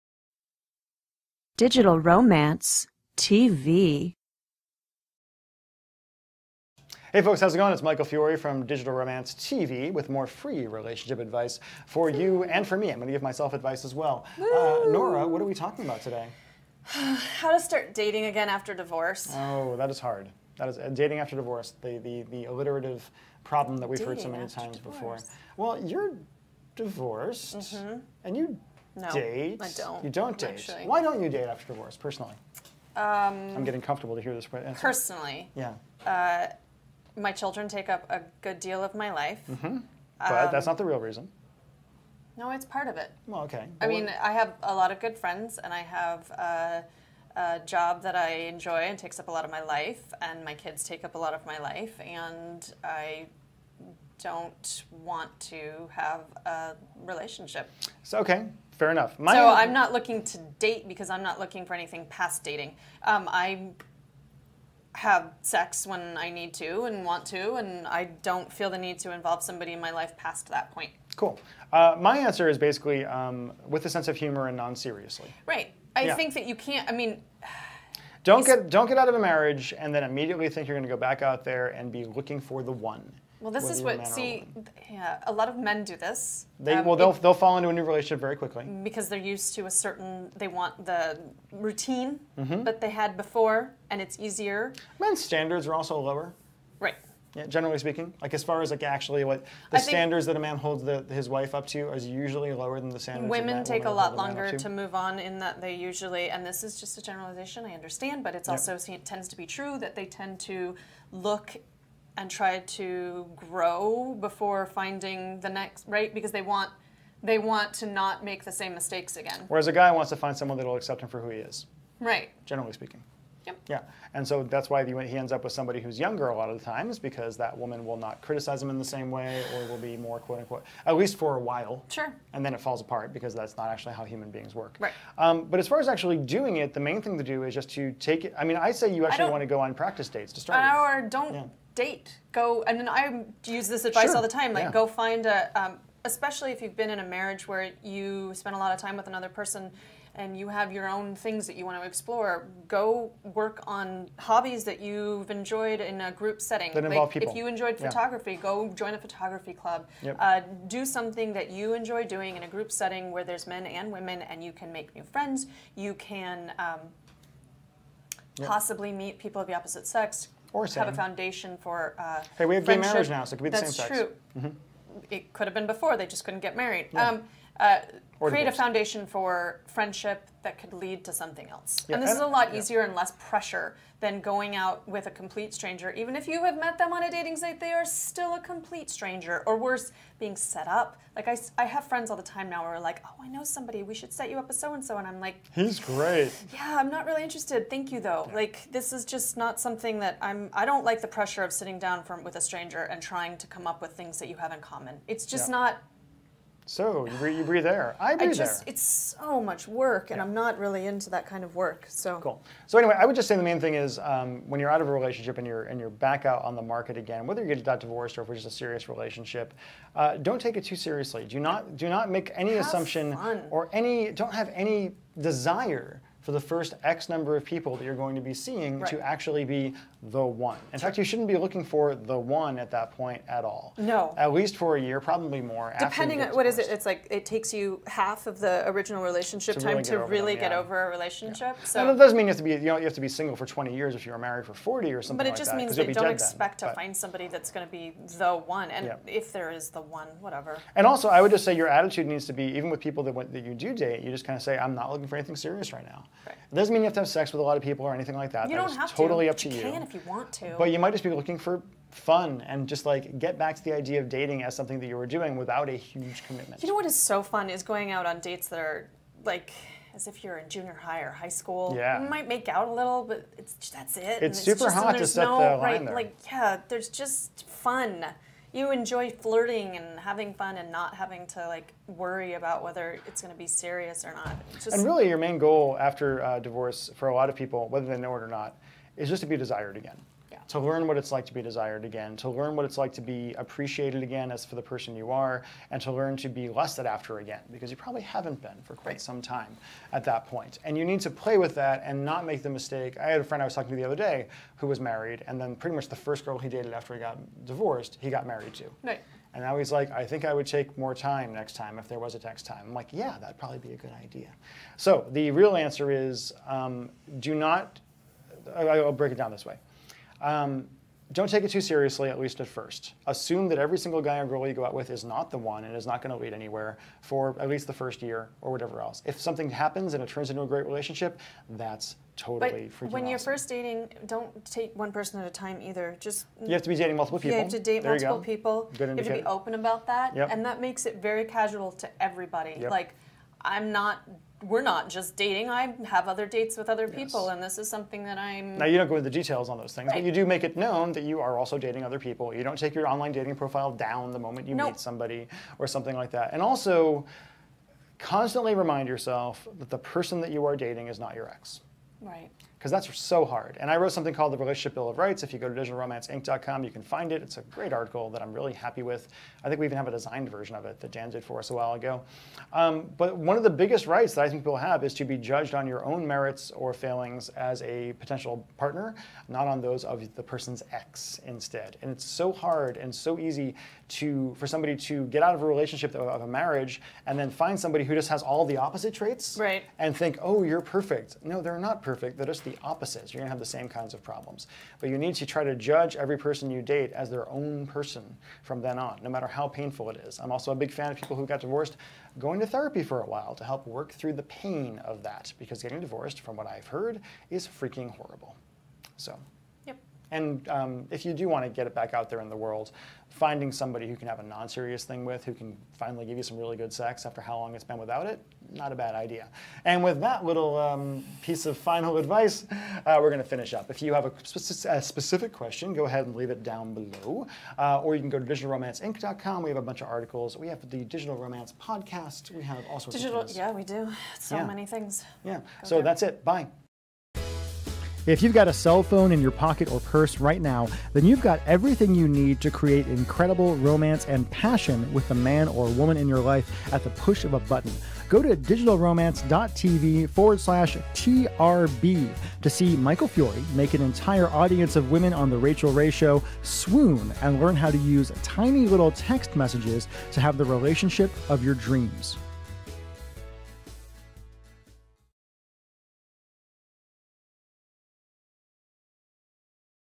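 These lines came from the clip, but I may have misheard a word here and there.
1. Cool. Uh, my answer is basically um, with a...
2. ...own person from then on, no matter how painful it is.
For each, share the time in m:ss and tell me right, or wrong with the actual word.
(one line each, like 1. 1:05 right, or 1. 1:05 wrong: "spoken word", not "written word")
1. 1:11 right
2. 6:37 right.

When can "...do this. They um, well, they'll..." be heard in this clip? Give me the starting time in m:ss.
1:25.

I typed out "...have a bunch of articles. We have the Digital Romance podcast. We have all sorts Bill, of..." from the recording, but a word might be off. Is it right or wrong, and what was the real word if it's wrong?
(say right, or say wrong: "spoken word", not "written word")
wrong: "Digital", not "Bill".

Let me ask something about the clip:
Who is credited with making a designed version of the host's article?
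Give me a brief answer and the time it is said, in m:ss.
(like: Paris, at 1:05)
Dan, at 6:10.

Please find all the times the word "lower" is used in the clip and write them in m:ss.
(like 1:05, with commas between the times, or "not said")
1:36, 1:42.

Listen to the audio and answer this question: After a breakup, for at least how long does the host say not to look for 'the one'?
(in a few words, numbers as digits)
a year.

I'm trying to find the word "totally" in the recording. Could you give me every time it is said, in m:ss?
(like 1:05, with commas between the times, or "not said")
4:18, 5:32.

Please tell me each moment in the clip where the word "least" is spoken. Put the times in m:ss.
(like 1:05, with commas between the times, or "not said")
2:10, 3:54, 5:22, 5:27.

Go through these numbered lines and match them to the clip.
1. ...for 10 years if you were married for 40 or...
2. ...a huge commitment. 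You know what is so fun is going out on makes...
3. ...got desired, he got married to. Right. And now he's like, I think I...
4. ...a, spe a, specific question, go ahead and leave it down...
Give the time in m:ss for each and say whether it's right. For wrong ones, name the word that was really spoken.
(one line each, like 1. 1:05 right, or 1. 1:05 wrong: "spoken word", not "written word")
1. 4:03 wrong: "20", not "10"
2. 4:25 wrong: "dates", not "makes"
3. 5:06 wrong: "divorced", not "desired"
4. 7:04 right.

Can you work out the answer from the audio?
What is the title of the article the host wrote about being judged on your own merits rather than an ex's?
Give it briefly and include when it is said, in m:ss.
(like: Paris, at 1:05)
Relationship Bill of Rights, at 6:04.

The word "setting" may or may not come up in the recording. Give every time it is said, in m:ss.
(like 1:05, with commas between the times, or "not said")
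2:36, 2:42.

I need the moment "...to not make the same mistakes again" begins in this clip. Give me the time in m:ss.
1:57.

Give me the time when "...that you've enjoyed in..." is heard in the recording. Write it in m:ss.
2:34.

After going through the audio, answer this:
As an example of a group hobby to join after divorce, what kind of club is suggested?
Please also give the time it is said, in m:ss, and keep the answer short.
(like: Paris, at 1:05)
photography club, at 2:38.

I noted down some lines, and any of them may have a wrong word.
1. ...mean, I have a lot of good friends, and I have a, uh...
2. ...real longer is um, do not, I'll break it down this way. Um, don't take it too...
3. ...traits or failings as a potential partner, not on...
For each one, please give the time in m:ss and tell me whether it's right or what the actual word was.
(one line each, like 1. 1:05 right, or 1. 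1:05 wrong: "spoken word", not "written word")
1. 0:43 right
2. 5:15 wrong: "answer", not "longer"
3. 6:16 wrong: "merits", not "traits".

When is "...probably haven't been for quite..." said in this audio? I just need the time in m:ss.
4:57.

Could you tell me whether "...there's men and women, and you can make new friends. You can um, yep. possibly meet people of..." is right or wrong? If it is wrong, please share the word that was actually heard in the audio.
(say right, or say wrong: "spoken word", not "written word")
right.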